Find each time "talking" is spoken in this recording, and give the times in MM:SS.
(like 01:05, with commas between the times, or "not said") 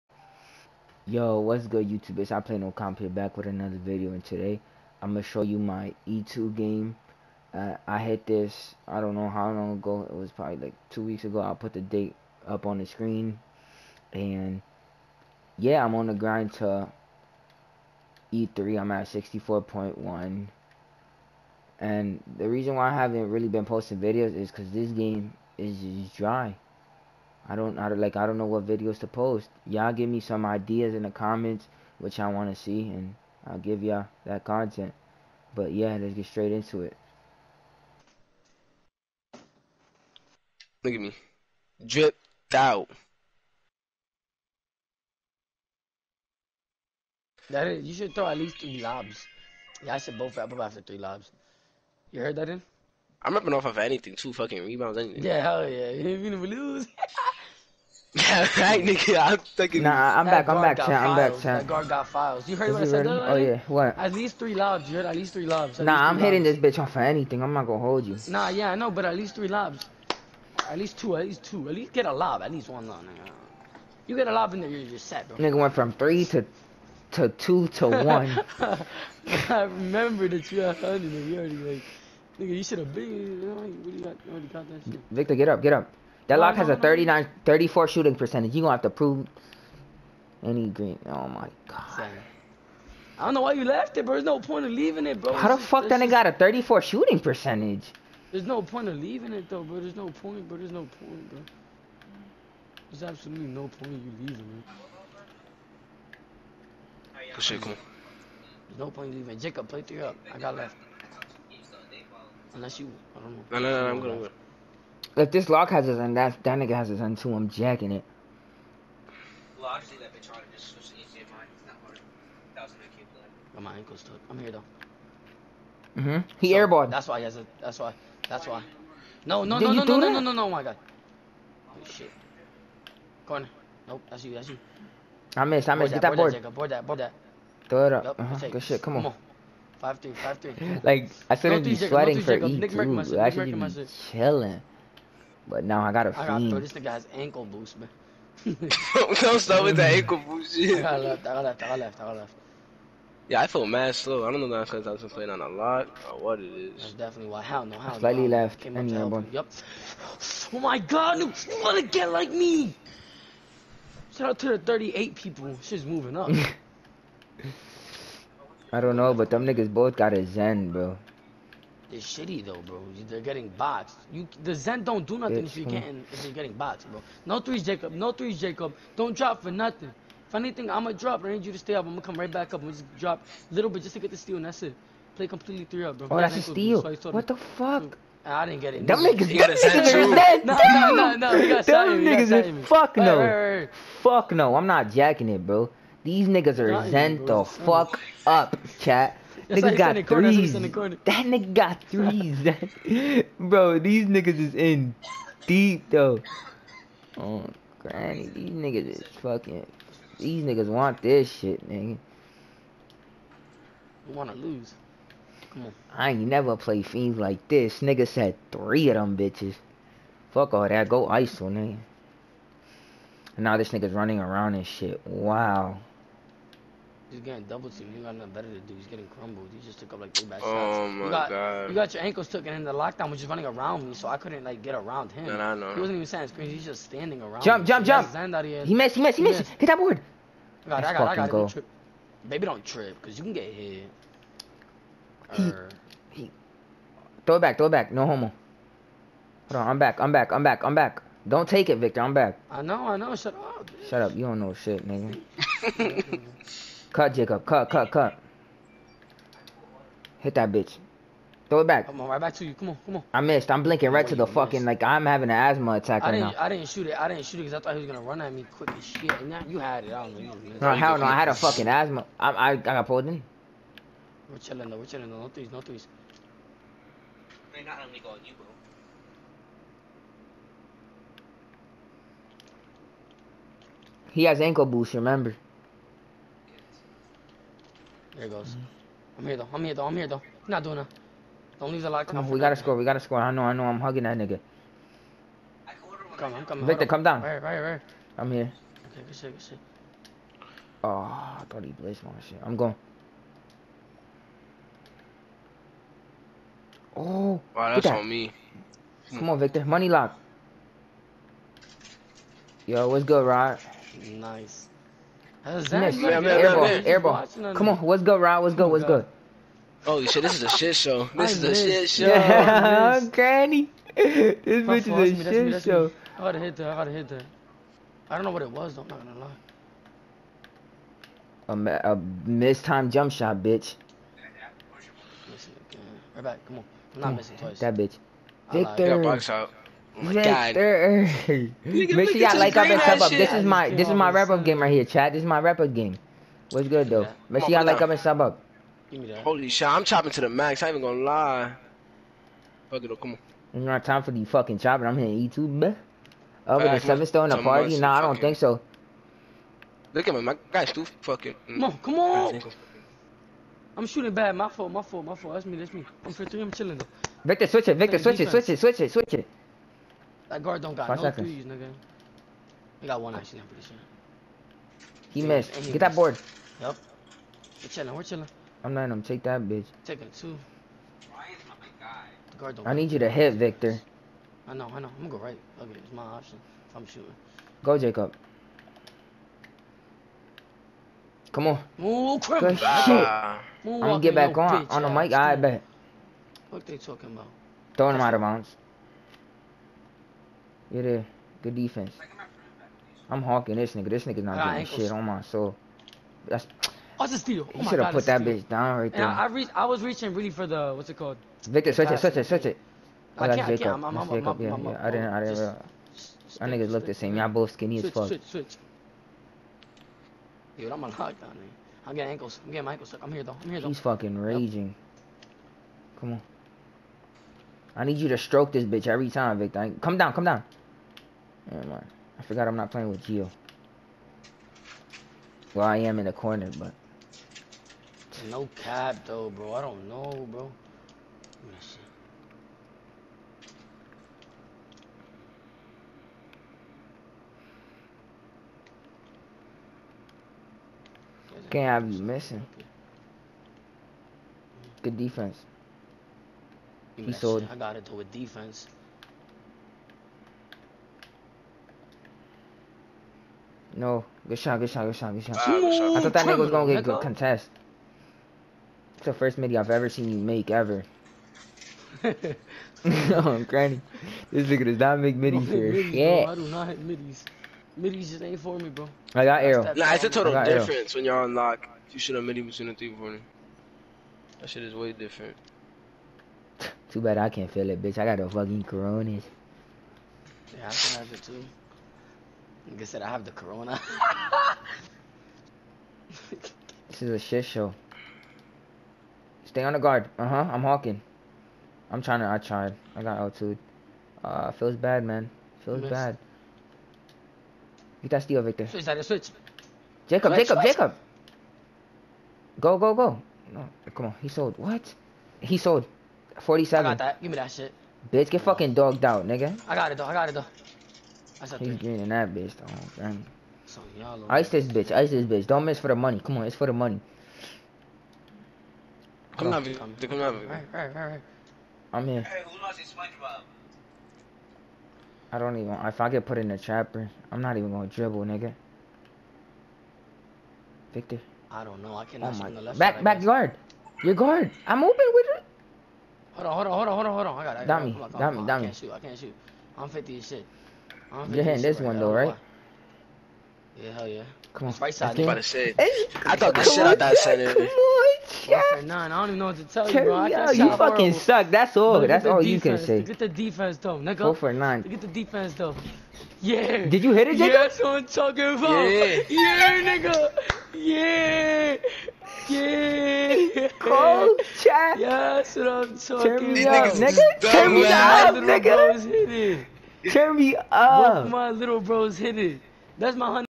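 06:36, 09:28, 09:35.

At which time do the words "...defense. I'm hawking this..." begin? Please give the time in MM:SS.
06:41.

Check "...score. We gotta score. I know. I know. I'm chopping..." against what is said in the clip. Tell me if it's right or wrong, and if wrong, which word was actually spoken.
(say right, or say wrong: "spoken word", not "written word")
wrong: "hugging", not "chopping".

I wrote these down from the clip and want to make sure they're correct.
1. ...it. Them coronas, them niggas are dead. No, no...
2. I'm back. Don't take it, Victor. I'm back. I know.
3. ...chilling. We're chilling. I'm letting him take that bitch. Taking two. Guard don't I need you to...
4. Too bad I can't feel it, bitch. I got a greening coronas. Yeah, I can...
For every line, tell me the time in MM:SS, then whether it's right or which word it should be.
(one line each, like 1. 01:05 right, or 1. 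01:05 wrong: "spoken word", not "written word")
1. 03:08 wrong: "niggas", not "coronas"
2. 04:10 right
3. 06:17 right
4. 08:06 wrong: "fucking", not "greening".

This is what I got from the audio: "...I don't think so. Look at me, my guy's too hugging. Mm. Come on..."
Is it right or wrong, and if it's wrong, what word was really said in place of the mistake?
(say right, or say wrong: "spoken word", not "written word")
wrong: "fucking", not "hugging".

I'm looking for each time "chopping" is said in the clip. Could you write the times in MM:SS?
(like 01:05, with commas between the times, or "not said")
05:49, 05:54.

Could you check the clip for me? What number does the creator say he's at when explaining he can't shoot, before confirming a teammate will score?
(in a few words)
50.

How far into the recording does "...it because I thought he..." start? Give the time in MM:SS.
04:27.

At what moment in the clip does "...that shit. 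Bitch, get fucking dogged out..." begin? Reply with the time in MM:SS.
08:37.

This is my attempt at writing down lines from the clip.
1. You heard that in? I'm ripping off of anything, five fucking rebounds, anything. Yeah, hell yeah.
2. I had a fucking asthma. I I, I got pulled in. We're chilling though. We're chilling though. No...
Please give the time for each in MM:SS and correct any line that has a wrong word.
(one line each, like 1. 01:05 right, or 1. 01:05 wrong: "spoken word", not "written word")
1. 00:52 wrong: "two", not "five"
2. 04:31 right.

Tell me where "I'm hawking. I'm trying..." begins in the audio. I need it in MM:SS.
08:20.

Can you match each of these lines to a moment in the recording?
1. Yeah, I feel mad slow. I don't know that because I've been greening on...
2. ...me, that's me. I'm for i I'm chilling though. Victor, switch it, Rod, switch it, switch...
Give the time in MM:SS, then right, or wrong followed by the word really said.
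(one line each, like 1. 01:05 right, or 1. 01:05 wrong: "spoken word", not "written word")
1. 02:33 wrong: "playing", not "greening"
2. 06:05 wrong: "Victor", not "Rod".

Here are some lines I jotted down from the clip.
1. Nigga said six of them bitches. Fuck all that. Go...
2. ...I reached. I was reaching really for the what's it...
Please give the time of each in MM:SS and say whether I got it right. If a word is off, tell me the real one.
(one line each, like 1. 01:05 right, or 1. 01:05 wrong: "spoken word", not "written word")
1. 03:37 wrong: "three", not "six"
2. 06:49 right.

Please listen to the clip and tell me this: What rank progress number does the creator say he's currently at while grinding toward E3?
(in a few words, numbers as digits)
64.1.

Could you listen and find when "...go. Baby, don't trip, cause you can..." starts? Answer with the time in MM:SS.
04:01.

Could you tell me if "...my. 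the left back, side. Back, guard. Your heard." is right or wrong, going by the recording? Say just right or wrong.
wrong.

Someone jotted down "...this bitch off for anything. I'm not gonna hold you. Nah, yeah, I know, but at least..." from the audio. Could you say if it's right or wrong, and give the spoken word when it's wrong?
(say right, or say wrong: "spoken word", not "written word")
right.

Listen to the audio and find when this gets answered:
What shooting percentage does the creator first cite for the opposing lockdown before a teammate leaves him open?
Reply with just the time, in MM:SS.
01:26.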